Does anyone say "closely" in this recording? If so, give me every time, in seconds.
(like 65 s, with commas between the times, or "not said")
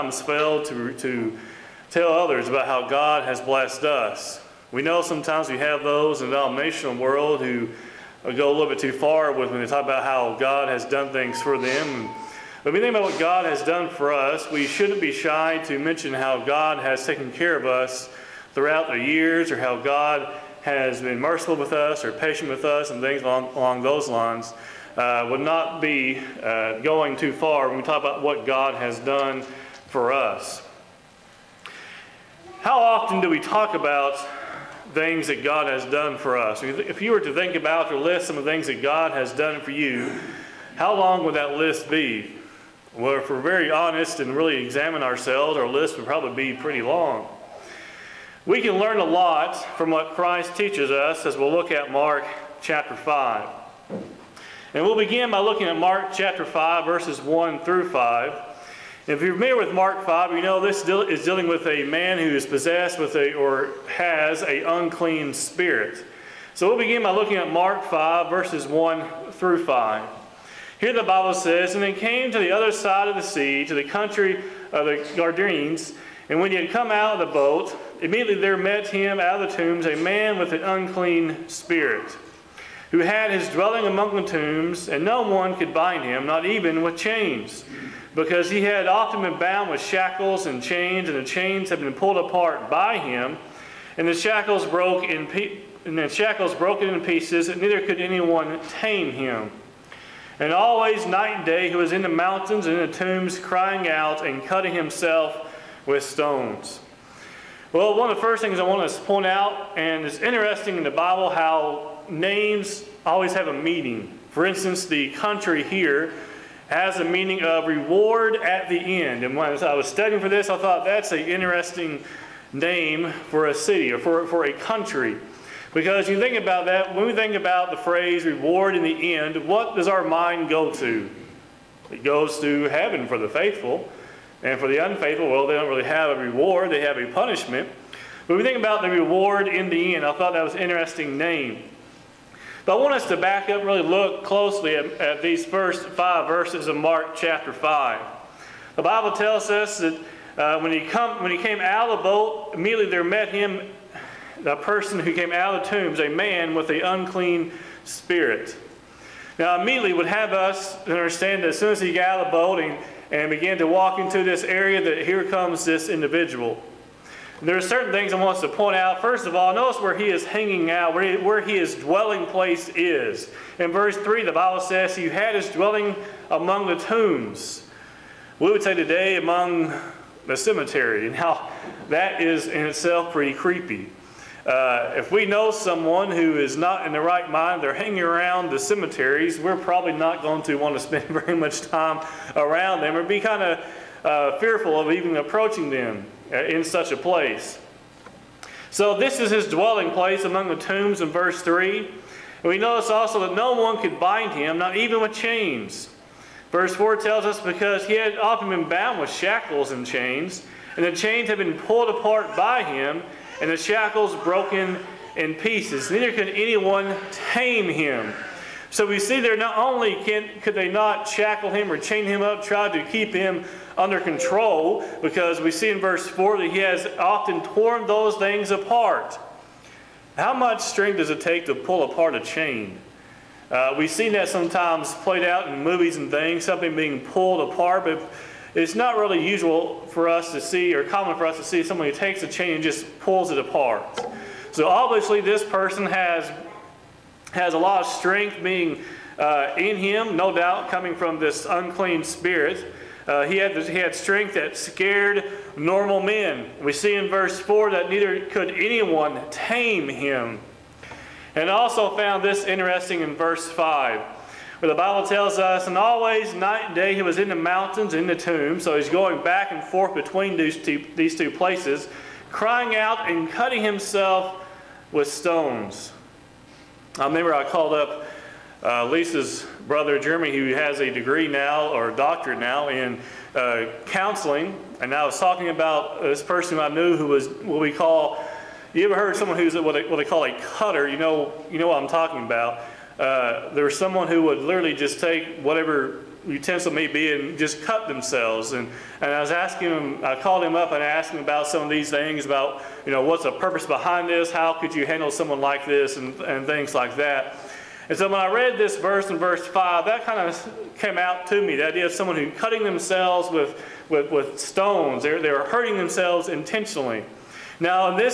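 144 s.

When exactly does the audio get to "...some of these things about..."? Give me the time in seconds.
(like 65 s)
301 s.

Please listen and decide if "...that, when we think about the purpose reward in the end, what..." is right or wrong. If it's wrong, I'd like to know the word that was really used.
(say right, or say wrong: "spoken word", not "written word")
wrong: "phrase", not "purpose".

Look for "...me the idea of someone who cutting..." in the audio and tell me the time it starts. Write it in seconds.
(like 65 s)
311 s.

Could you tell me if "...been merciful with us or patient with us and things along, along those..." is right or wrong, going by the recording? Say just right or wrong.
right.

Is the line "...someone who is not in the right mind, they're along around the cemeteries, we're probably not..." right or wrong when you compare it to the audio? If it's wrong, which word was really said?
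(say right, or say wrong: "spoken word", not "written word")
wrong: "hanging", not "along".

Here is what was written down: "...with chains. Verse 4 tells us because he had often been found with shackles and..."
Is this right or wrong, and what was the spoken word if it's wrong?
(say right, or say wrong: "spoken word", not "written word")
wrong: "bound", not "found".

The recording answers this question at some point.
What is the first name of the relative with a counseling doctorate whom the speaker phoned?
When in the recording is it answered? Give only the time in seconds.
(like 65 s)
279 s.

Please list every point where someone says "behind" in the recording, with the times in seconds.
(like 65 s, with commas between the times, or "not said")
303 s.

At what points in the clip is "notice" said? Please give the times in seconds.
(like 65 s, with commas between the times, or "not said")
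169 s, 202 s.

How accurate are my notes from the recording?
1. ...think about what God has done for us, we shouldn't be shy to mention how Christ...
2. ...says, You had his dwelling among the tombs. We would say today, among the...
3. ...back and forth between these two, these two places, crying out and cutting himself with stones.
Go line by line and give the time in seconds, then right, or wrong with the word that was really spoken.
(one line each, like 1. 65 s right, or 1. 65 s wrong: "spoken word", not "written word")
1. 12 s wrong: "God", not "Christ"
2. 174 s right
3. 269 s right.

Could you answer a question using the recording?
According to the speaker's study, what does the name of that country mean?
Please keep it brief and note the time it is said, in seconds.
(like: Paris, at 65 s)
reward at the end, at 117 s.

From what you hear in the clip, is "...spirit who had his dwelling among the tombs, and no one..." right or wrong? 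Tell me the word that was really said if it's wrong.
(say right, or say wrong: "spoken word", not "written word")
right.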